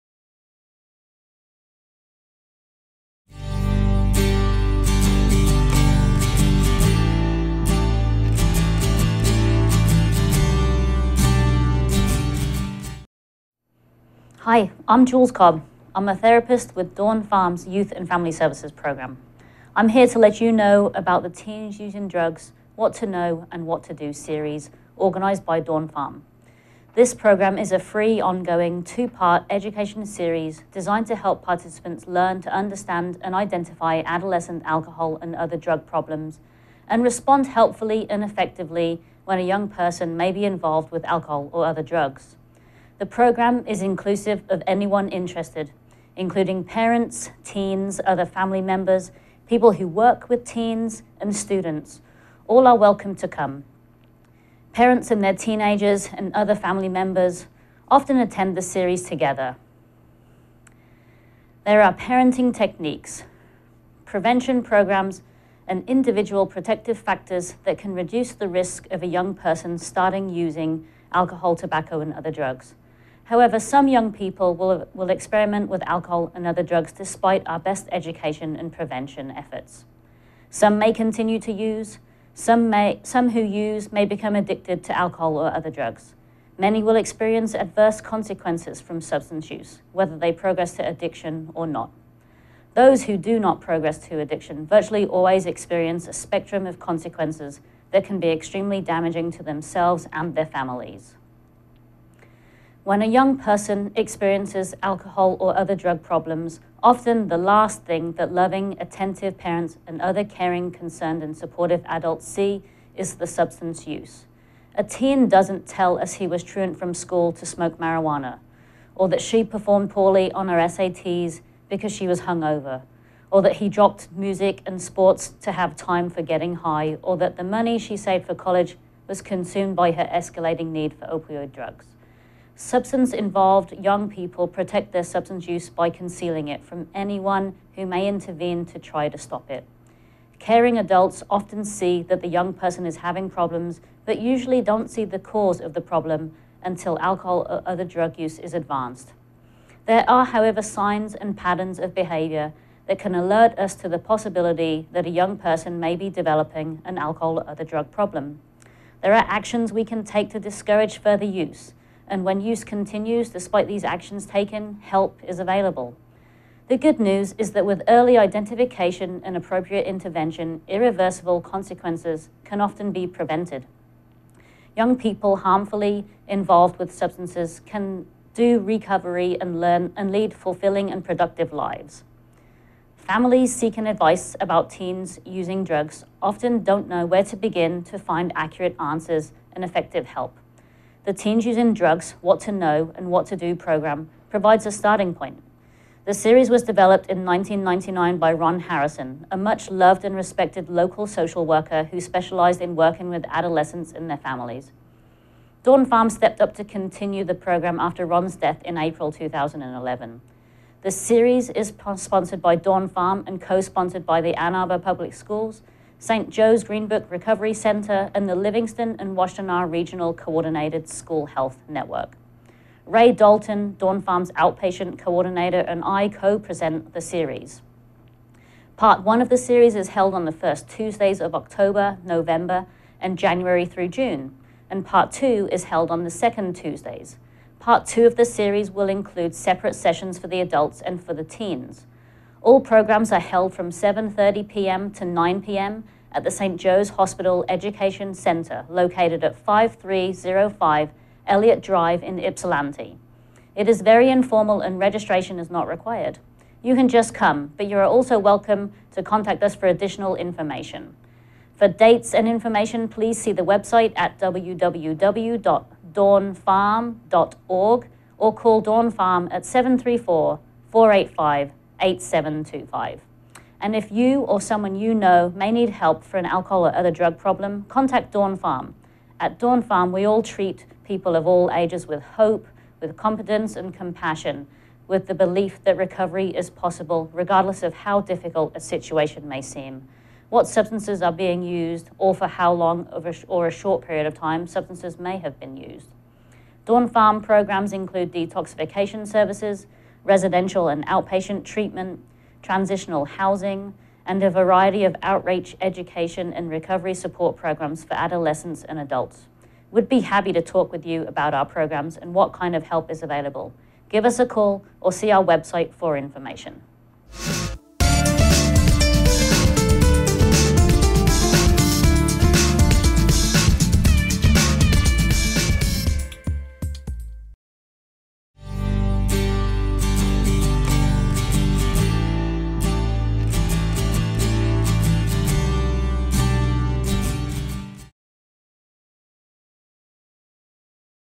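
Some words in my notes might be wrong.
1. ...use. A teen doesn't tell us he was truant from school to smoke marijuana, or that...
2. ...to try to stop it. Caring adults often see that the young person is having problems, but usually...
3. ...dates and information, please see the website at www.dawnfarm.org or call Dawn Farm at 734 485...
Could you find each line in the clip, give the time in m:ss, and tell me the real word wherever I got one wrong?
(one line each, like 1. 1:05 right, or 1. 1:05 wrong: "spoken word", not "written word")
1. 1:53 right
2. 2:18 right
3. 4:21 right.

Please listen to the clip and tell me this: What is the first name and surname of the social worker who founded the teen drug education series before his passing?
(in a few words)
Ron Harrison.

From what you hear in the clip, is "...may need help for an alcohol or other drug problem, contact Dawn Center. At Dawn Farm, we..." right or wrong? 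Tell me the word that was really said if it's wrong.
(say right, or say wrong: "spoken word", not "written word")
wrong: "Farm", not "Center".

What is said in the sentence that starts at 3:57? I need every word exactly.
Part two of the series will include separate sessions for the adults and for the teens.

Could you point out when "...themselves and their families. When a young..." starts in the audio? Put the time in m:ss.
1:39.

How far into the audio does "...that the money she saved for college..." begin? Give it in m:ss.
2:07.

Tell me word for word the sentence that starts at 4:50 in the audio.
What substances are being used, or for how long or a short period of time substances may have been used.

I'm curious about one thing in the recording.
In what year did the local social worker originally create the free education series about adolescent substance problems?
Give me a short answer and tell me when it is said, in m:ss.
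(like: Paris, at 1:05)
1999, at 3:17.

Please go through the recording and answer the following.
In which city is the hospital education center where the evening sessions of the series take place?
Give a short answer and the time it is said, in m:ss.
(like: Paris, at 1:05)
Ypsilanti, at 4:12.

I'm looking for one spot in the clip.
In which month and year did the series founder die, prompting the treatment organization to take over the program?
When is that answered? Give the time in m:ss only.
3:28.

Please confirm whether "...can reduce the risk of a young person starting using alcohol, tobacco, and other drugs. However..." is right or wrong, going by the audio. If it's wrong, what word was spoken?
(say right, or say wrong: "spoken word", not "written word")
right.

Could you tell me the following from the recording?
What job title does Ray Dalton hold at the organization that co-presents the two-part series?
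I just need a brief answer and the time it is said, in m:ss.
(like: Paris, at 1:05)
Outpatient coordinator, at 3:44.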